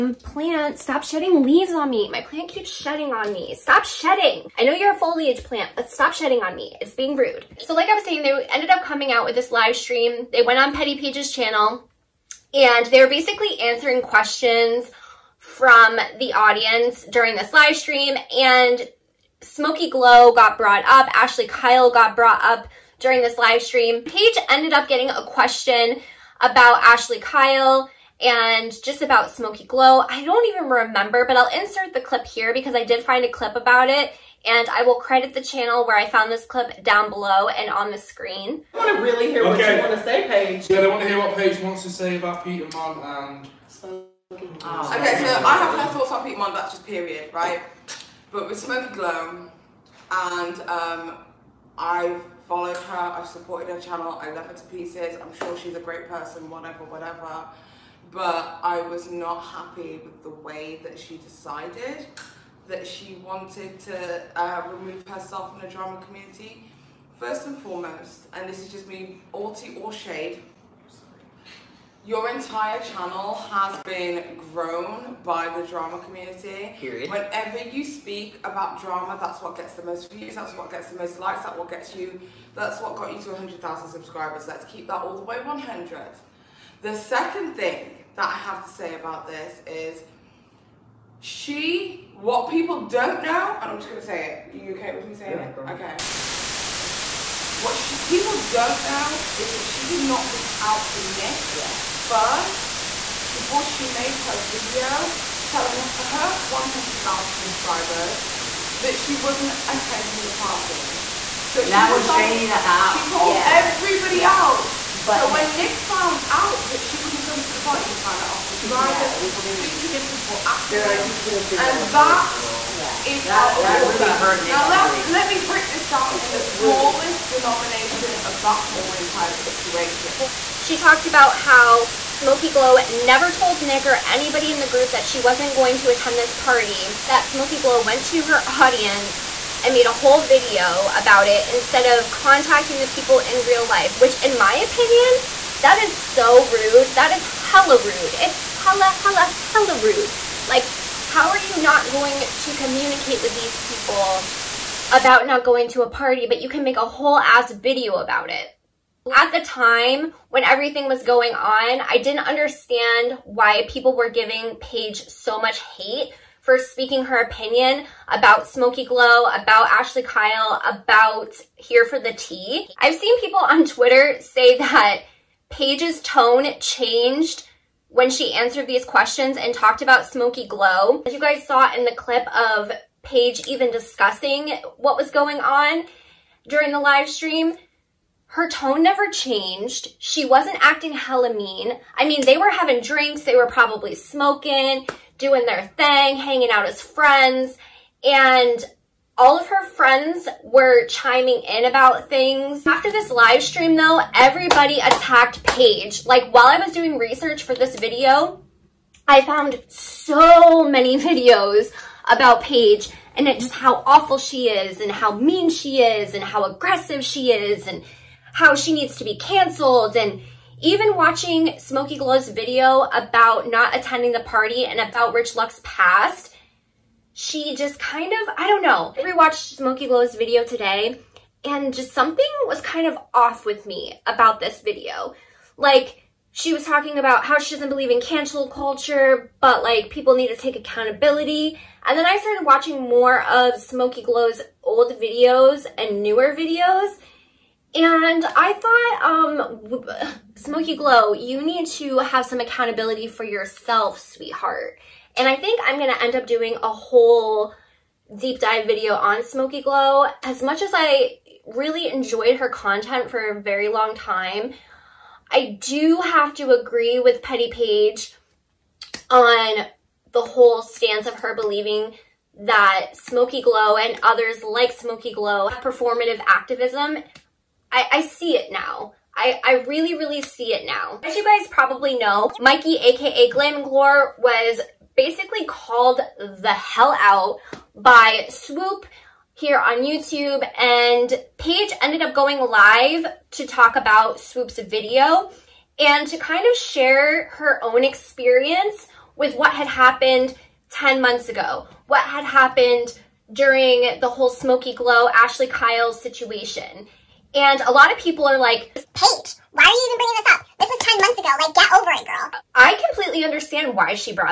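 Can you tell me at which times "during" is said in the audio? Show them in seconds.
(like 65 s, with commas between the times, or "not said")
17 s, 22 s, 186 s, 303 s.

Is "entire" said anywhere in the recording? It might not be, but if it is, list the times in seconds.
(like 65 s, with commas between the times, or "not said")
72 s, 128 s.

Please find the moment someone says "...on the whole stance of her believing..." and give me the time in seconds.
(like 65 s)
269 s.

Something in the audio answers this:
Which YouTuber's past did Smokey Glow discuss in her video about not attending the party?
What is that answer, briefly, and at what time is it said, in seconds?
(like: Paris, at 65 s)
Rich Lux, at 225 s.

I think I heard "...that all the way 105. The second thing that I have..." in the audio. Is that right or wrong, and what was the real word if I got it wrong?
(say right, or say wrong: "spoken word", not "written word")
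wrong: "100", not "105".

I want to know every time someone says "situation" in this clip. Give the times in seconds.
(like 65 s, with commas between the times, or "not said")
129 s, 305 s.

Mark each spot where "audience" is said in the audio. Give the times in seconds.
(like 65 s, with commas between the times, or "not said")
16 s, 138 s.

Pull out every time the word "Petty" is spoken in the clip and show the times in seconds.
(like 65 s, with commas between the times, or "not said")
10 s, 267 s.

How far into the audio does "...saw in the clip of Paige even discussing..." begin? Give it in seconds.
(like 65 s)
181 s.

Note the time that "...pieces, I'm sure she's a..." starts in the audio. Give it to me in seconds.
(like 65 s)
54 s.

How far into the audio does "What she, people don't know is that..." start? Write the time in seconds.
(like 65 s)
97 s.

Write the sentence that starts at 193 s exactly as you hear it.
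They were probably smoking, doing their thing, hanging out as friends.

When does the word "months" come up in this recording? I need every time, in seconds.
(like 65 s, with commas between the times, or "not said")
300 s, 310 s.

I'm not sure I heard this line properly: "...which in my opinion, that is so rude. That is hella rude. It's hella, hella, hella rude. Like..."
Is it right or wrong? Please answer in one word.
right.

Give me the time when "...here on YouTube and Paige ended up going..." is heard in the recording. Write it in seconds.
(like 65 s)
289 s.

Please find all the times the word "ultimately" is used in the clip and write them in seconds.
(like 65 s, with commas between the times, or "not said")
not said.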